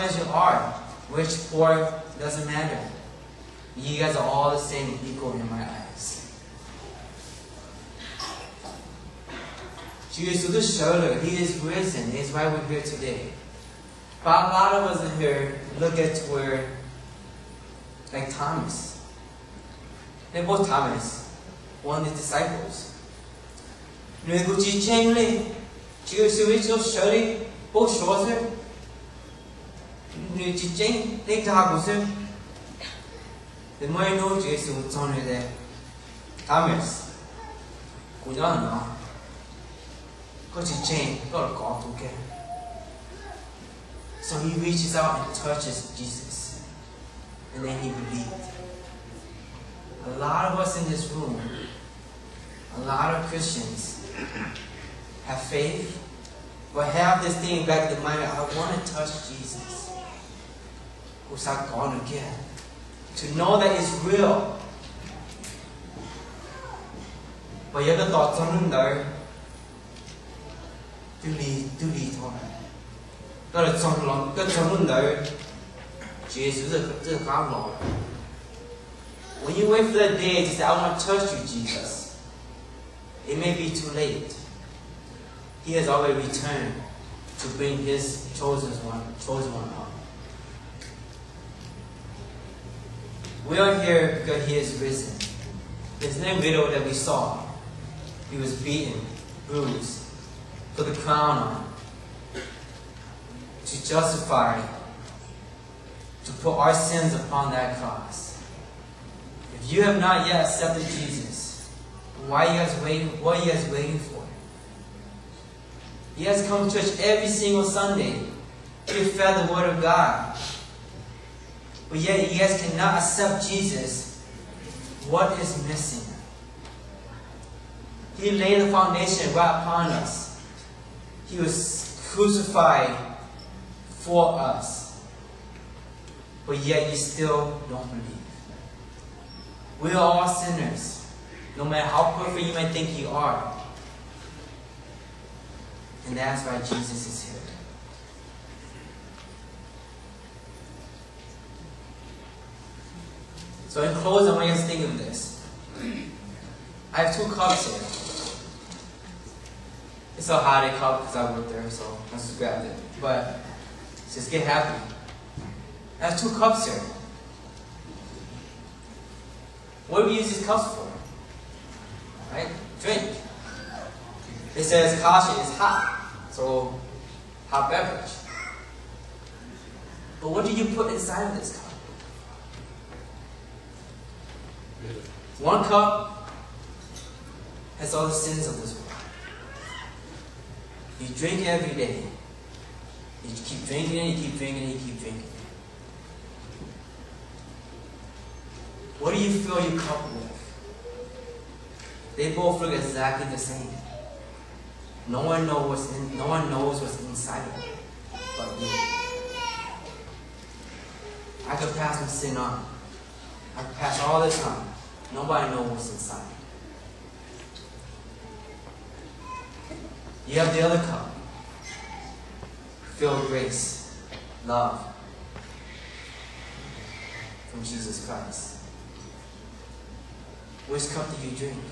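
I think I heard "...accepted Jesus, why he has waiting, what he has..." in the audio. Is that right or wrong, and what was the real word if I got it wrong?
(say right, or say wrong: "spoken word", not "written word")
right.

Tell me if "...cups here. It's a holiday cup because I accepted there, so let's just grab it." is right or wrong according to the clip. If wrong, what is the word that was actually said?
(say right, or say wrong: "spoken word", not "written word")
wrong: "worked", not "accepted".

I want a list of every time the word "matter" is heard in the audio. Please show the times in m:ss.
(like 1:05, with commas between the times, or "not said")
0:02, 2:21.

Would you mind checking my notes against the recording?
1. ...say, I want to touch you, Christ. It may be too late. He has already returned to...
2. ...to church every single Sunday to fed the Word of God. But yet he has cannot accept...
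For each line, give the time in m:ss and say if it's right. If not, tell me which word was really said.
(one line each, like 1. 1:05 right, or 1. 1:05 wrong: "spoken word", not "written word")
1. 1:20 wrong: "Jesus", not "Christ"
2. 1:56 right.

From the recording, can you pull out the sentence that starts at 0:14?
But a lot of us in here look at where, like Thomas.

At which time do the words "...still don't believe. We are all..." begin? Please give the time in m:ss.
2:16.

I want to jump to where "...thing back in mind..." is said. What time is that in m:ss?
0:57.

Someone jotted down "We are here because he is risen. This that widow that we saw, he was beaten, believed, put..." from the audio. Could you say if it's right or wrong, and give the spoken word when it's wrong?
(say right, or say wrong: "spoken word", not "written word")
wrong: "bruised", not "believed".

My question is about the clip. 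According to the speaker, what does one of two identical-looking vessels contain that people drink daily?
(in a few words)
all the sins of this world.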